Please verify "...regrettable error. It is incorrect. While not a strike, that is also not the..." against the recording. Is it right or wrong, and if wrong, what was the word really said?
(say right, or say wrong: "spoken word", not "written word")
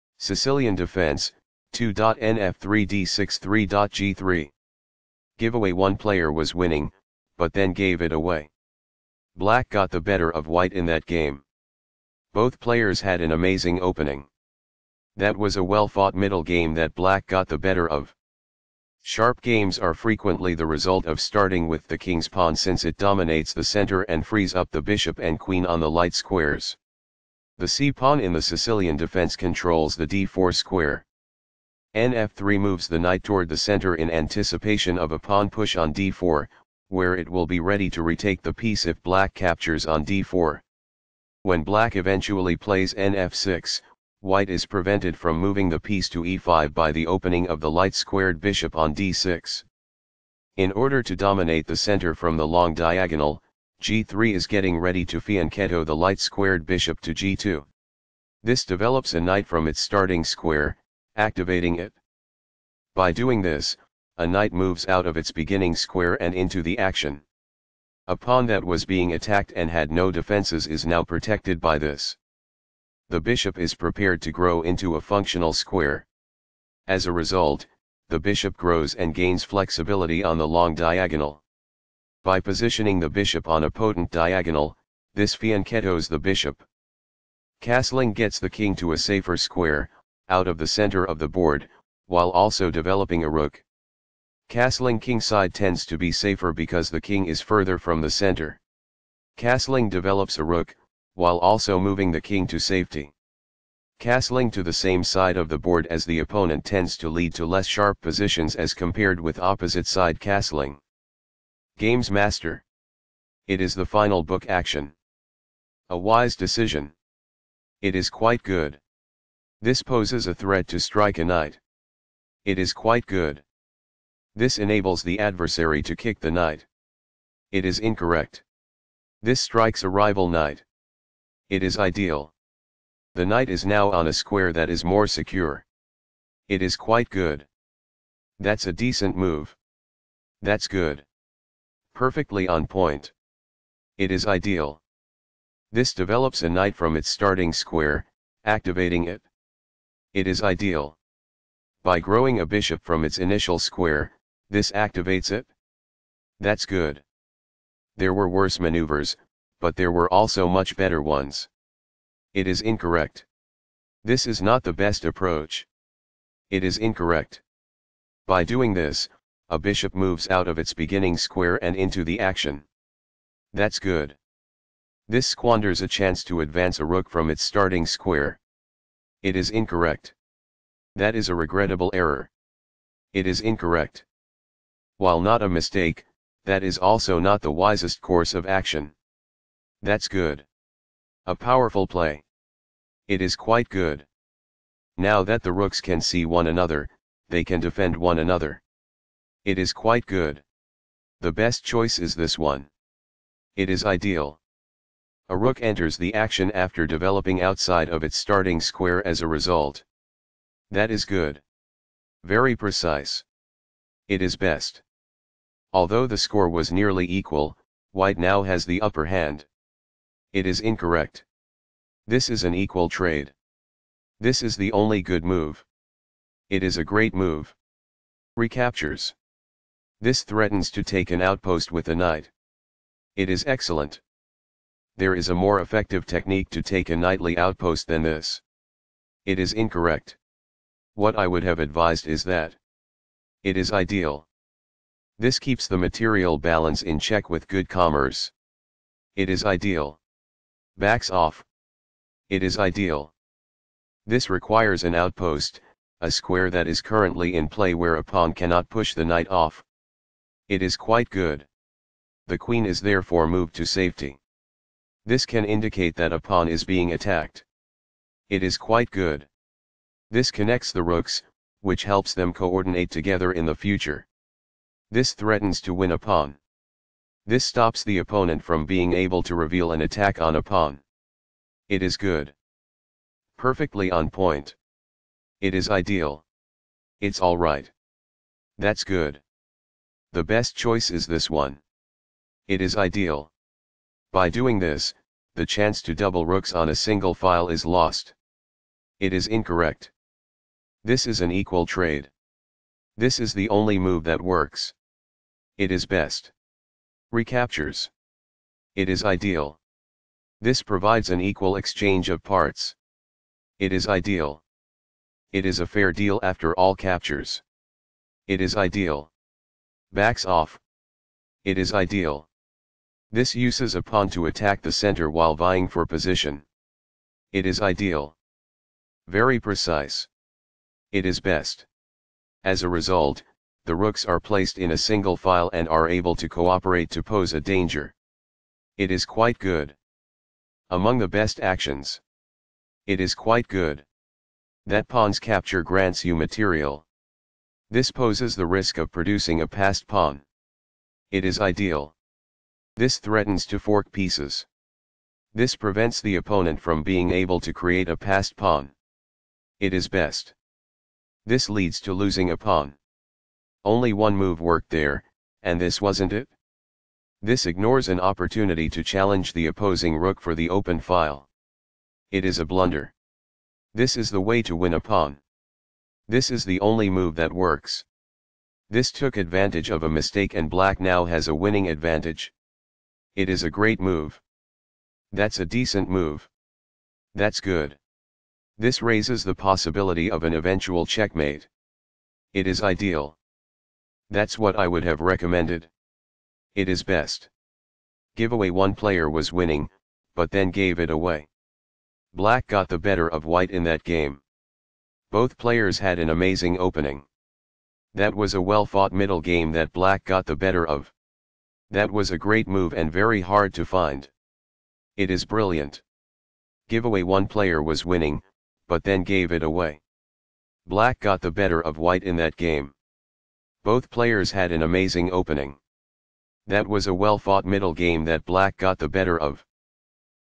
wrong: "mistake", not "strike".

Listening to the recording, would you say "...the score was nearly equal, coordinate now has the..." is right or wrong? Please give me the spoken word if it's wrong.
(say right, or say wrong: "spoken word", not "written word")
wrong: "white", not "coordinate".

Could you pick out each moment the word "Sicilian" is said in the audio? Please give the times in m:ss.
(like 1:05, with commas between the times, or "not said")
0:00, 0:28.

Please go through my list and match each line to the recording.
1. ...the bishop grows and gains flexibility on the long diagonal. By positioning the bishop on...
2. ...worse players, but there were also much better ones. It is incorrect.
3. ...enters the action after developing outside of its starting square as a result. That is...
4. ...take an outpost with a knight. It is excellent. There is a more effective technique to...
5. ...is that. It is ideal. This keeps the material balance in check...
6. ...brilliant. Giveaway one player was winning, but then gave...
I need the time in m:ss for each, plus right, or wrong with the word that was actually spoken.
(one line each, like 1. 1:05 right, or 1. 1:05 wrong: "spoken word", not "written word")
1. 1:18 right
2. 2:38 wrong: "maneuvers", not "players"
3. 3:25 right
4. 3:50 right
5. 4:02 right
6. 6:55 right.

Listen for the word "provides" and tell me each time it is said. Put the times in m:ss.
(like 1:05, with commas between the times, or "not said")
5:10.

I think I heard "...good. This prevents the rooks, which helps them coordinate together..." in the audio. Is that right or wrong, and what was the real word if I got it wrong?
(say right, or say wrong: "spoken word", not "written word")
wrong: "connects", not "prevents".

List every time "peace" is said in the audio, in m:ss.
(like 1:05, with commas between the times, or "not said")
not said.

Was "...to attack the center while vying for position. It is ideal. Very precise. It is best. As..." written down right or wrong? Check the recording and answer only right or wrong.
right.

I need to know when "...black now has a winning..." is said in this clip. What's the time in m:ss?
6:20.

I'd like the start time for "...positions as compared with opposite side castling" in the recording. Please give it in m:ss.
1:47.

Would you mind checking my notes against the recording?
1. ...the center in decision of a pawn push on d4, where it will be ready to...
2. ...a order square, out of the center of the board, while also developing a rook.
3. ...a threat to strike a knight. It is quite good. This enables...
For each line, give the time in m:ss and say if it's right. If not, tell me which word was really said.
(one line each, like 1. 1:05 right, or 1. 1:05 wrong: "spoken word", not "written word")
1. 0:33 wrong: "anticipation", not "decision"
2. 1:28 wrong: "safer", not "order"
3. 2:00 right.